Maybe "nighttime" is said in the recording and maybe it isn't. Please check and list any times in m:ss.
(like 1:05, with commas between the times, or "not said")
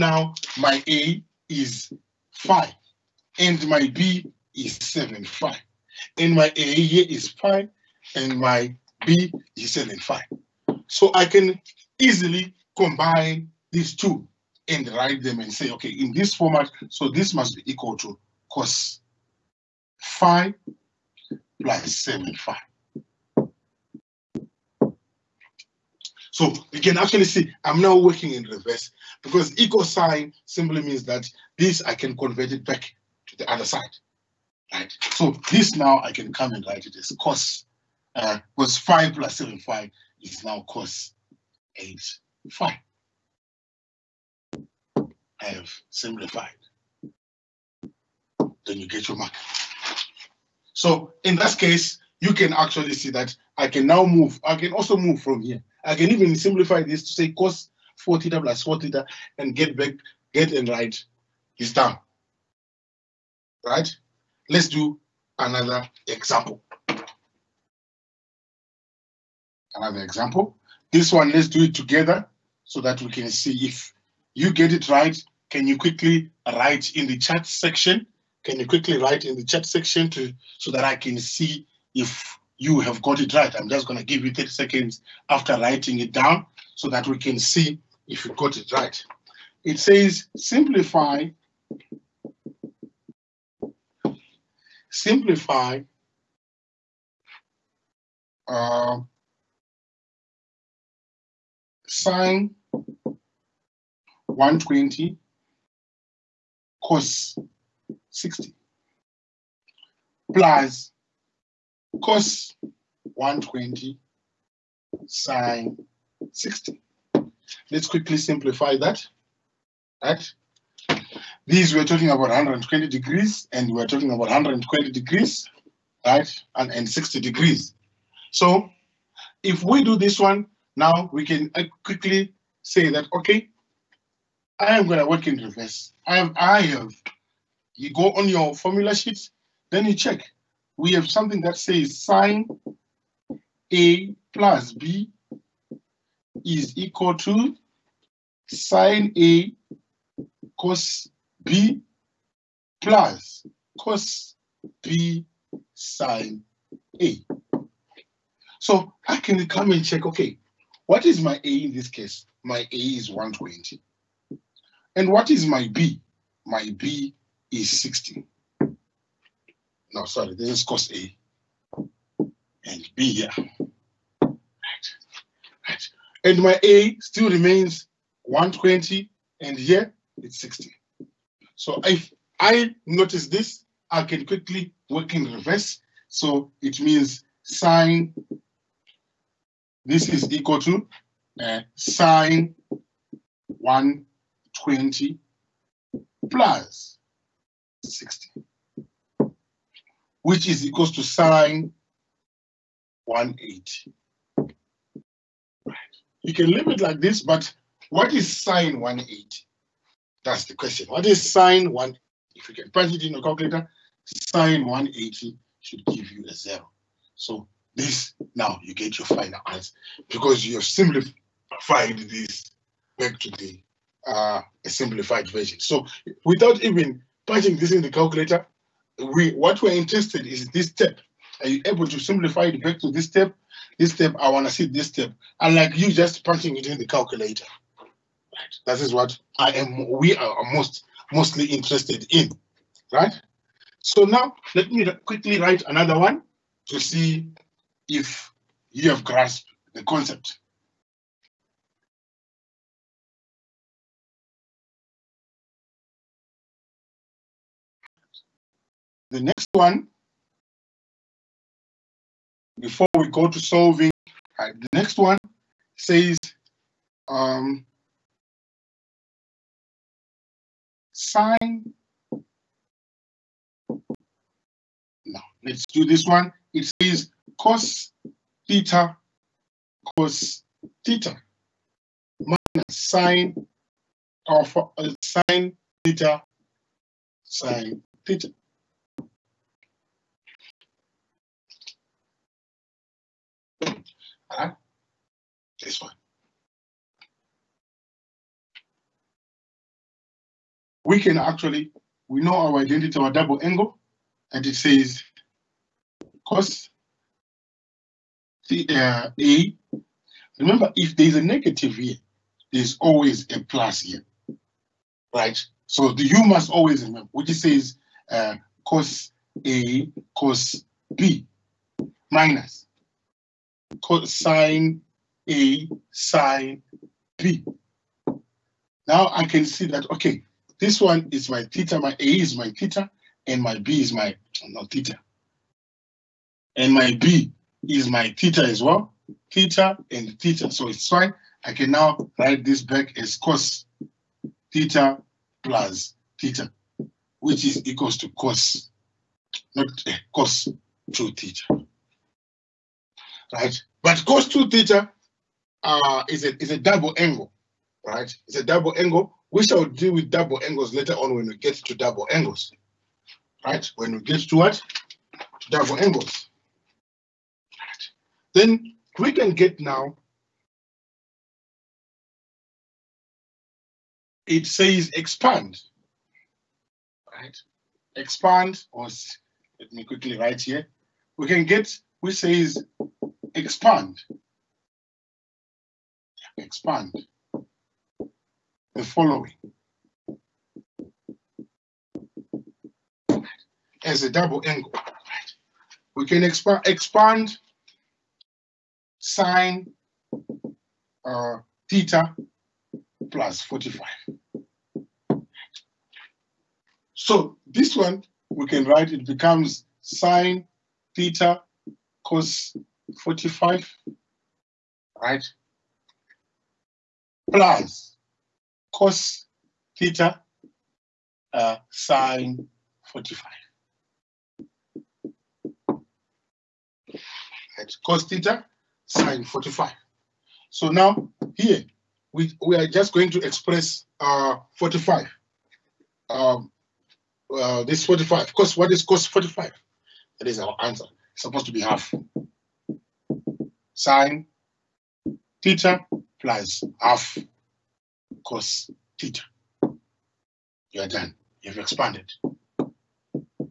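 not said.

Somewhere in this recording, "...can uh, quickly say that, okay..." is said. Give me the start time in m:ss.
2:11.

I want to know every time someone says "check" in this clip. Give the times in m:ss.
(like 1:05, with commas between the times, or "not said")
2:19, 2:39.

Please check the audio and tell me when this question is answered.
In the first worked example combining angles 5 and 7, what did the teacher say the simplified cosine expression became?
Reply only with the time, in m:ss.
0:40.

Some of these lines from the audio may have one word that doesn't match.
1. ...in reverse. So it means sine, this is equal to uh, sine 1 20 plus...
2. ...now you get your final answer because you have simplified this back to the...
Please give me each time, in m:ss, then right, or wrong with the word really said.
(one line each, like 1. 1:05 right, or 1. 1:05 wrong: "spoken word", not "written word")
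1. 3:05 right
2. 3:38 right.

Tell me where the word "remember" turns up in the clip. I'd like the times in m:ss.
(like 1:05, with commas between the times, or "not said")
5:10, 5:16.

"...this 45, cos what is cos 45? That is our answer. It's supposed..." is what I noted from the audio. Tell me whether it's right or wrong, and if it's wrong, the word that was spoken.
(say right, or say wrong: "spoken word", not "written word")
right.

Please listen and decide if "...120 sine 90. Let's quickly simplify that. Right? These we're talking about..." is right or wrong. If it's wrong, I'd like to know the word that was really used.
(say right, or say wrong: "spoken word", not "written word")
wrong: "60", not "90".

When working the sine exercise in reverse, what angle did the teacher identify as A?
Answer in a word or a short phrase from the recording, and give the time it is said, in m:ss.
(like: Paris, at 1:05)
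120, at 2:42.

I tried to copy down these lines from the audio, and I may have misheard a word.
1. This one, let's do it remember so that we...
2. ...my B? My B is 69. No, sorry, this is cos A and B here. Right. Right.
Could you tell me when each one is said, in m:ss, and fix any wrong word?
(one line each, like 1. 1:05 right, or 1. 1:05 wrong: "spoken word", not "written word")
1. 1:10 wrong: "together", not "remember"
2. 2:45 wrong: "60", not "69".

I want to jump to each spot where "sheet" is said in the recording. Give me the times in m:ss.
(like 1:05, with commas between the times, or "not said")
2:18.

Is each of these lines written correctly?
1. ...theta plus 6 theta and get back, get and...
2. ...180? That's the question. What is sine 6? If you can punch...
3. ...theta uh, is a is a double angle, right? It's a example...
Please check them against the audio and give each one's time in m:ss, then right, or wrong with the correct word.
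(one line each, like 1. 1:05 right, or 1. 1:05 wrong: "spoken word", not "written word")
1. 0:58 wrong: "4", not "6"
2. 3:28 wrong: "1", not "6"
3. 5:54 wrong: "double", not "example".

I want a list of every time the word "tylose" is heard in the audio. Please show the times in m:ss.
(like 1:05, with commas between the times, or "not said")
not said.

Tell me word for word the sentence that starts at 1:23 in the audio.
I'm just going to give you 30 seconds after writing it down so that we can see if you got it right.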